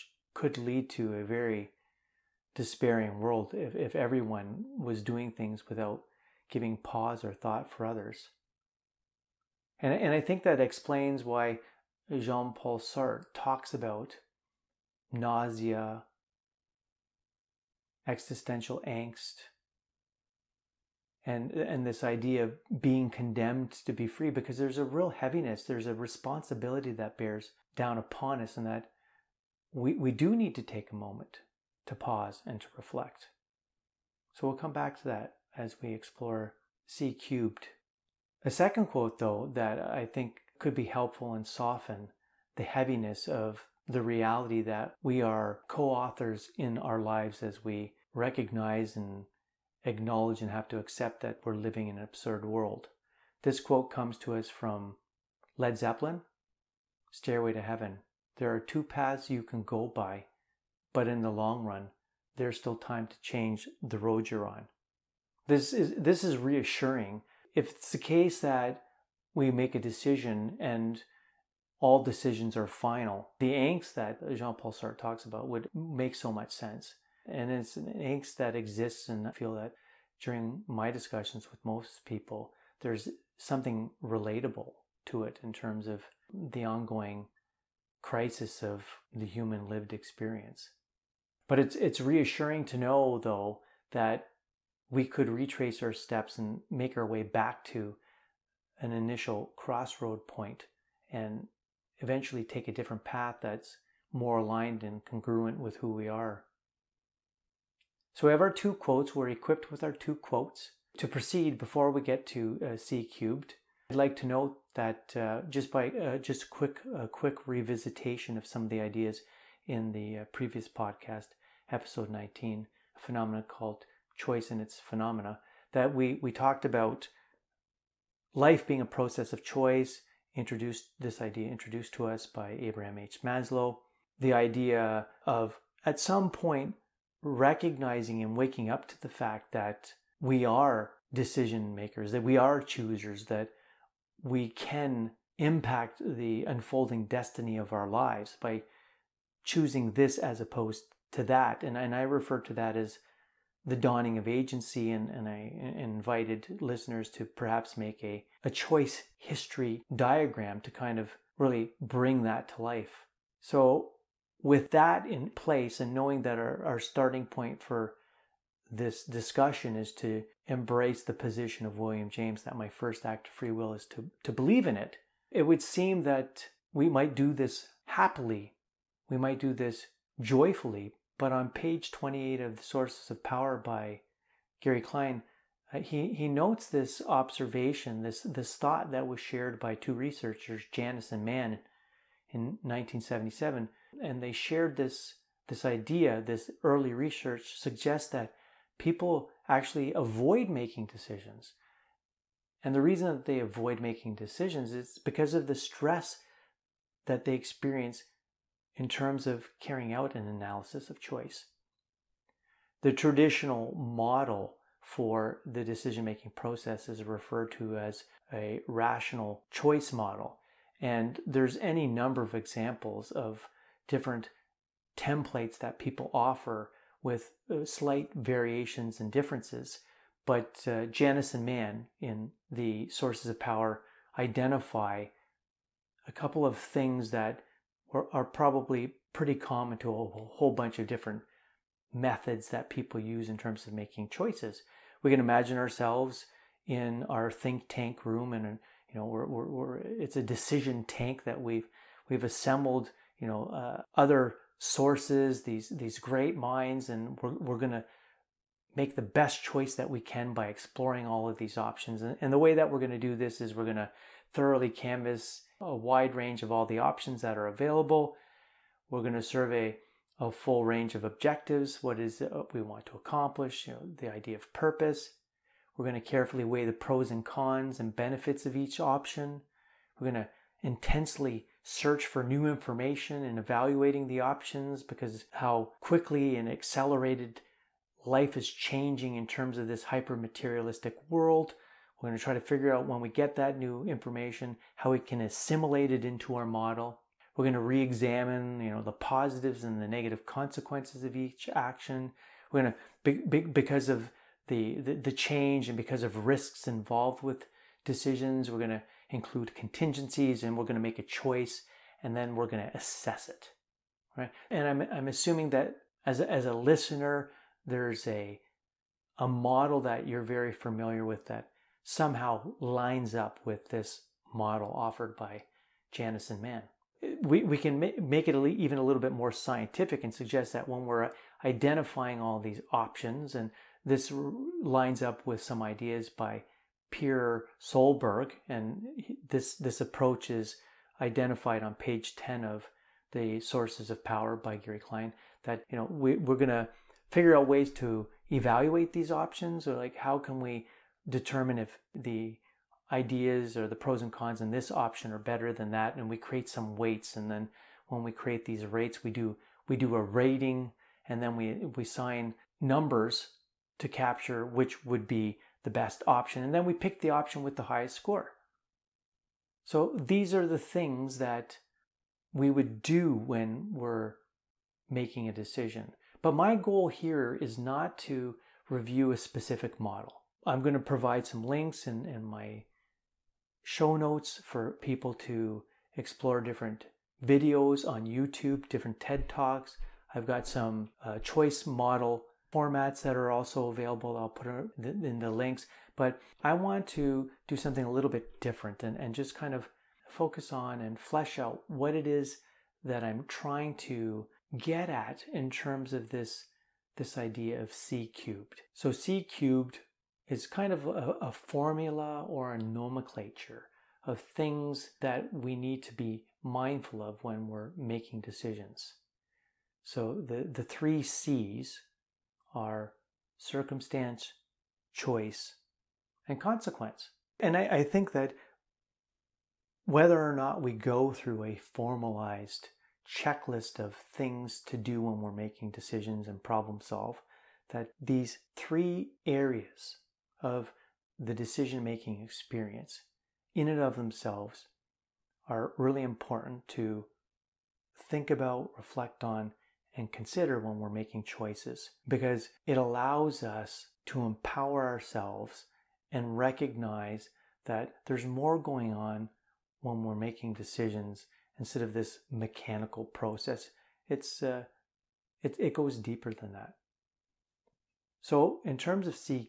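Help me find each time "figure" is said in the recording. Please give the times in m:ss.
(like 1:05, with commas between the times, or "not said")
4:52, 5:47.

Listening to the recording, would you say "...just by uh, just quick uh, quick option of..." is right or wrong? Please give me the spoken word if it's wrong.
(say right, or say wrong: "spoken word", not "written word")
wrong: "revisitation", not "option".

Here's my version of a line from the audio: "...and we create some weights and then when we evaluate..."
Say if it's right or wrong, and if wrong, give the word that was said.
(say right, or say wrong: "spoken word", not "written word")
wrong: "create", not "evaluate".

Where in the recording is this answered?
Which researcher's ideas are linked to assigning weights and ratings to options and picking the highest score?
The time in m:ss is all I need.
5:36.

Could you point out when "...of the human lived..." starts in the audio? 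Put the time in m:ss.
1:28.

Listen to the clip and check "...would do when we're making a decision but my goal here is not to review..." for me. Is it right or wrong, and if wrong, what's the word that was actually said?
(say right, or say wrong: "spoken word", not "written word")
right.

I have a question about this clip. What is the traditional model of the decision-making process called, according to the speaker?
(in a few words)
rational choice model.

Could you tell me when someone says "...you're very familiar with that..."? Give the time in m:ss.
5:20.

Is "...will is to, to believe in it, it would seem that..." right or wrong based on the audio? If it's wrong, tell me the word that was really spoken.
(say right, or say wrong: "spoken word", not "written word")
right.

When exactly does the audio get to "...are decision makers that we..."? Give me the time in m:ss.
2:20.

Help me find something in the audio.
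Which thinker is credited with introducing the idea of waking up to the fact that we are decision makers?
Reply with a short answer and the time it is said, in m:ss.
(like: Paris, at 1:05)
Abraham H Maslow, at 2:12.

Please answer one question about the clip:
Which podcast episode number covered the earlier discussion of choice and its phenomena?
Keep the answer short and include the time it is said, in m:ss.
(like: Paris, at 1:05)
19, at 2:01.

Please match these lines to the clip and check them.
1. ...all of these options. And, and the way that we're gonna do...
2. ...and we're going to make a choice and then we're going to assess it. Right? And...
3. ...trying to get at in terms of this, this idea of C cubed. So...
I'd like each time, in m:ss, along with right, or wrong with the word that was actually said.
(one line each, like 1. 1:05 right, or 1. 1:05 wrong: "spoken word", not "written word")
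1. 4:21 right
2. 5:10 right
3. 6:43 right.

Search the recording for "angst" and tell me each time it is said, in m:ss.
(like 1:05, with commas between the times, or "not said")
0:18, 1:13, 1:17.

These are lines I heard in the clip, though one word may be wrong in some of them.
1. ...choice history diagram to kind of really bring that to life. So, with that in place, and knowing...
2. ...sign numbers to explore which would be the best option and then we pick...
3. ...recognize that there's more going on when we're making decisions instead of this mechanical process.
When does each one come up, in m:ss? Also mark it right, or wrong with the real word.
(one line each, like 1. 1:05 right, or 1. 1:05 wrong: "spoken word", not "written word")
1. 2:38 right
2. 6:01 wrong: "capture", not "explore"
3. 7:36 right.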